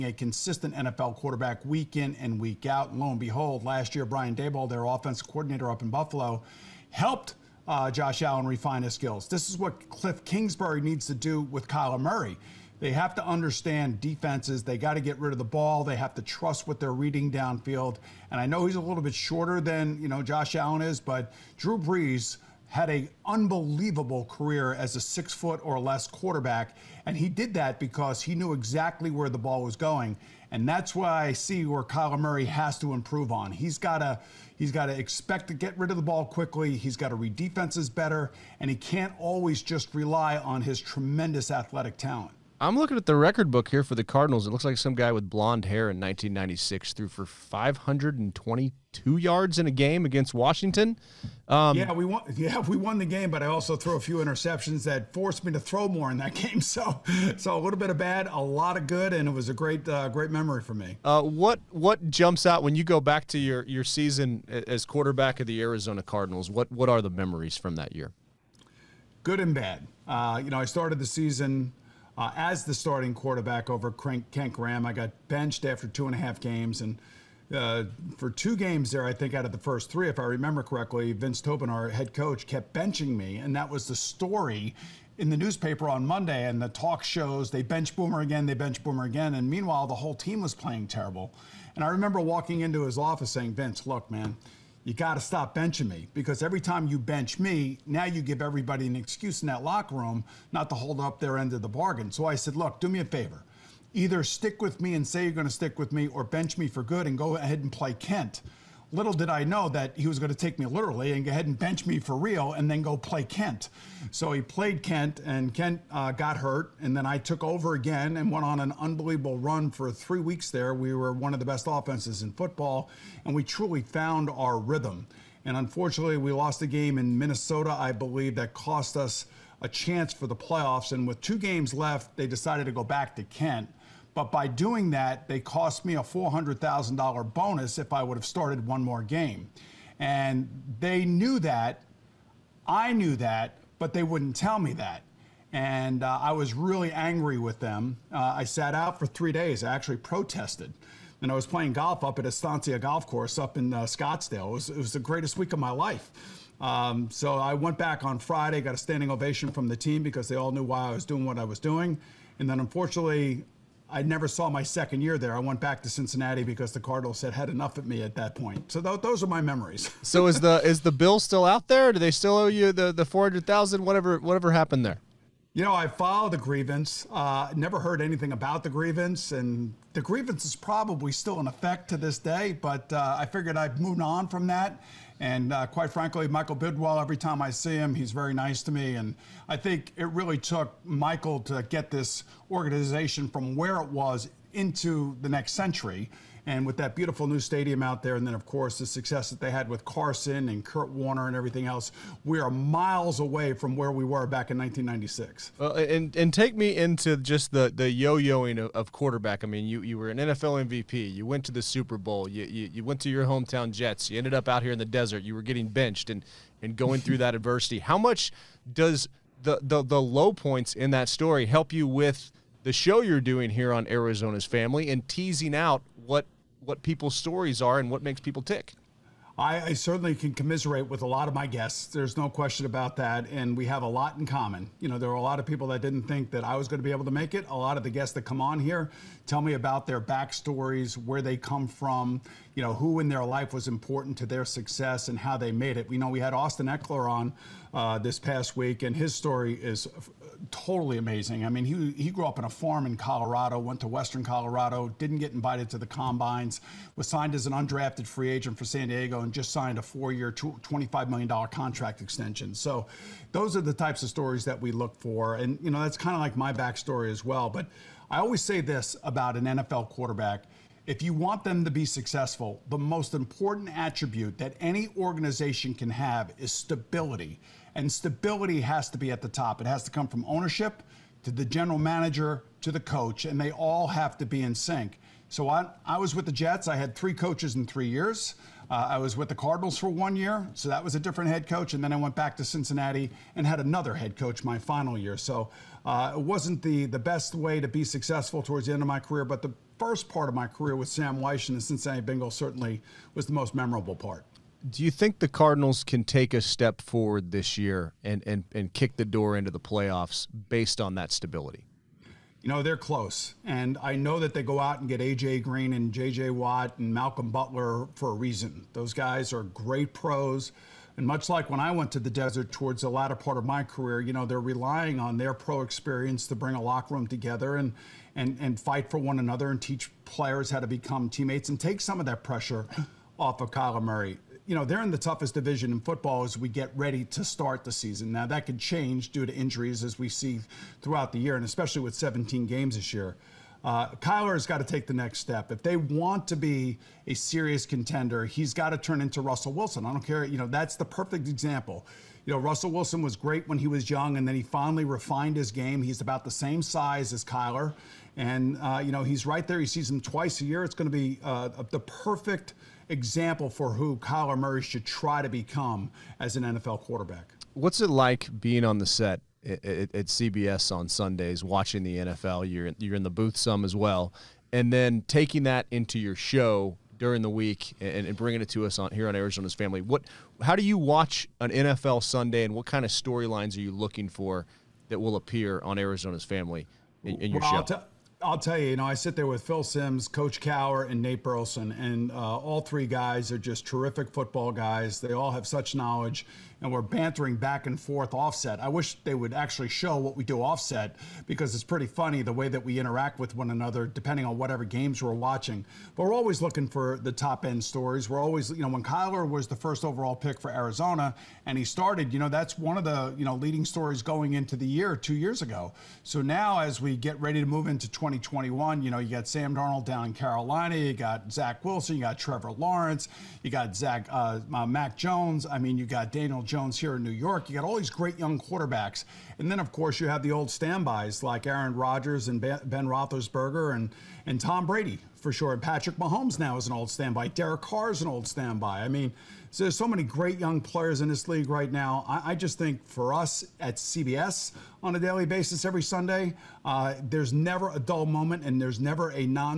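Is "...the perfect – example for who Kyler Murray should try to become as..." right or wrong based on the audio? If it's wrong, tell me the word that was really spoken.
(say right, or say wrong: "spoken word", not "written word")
right.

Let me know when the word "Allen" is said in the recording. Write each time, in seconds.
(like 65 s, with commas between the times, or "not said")
8 s, 20 s.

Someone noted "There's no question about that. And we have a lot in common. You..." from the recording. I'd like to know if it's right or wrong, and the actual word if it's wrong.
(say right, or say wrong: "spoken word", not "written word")
right.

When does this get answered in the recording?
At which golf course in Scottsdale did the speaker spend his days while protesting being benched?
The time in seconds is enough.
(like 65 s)
152 s.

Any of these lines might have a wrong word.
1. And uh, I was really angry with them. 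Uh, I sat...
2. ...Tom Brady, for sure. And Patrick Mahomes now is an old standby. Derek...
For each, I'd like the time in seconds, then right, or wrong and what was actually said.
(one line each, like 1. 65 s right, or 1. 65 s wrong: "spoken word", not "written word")
1. 145 s right
2. 434 s right.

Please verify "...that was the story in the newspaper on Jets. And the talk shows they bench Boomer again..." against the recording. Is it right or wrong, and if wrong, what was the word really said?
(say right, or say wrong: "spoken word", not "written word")
wrong: "Monday", not "Jets".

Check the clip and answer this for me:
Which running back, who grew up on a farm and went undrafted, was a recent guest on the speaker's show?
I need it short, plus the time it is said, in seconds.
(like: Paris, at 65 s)
Austin Ekeler, at 246 s.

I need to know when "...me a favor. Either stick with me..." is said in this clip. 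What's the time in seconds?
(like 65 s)
102 s.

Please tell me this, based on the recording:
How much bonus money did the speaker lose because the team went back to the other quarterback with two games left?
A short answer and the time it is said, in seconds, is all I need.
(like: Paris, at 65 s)
$400,000, at 136 s.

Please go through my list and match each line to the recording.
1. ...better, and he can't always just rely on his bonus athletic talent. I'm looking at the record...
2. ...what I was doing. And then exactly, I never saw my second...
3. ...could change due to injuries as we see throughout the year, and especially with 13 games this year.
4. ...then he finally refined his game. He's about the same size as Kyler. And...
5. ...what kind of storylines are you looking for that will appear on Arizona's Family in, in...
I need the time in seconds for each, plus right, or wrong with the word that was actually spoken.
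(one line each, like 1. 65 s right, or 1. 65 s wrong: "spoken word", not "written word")
1. 37 s wrong: "tremendous", not "bonus"
2. 161 s wrong: "unfortunately", not "exactly"
3. 338 s wrong: "17", not "13"
4. 354 s right
5. 382 s right.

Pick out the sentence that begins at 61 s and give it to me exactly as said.
Uh, what what jumps out when you go back to your your season as quarterback of the Arizona Cardinals?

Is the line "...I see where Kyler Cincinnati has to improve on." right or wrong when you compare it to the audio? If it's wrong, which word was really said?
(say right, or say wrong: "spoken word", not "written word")
wrong: "Murray", not "Cincinnati".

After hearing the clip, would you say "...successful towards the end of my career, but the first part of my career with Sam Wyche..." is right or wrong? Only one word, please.
right.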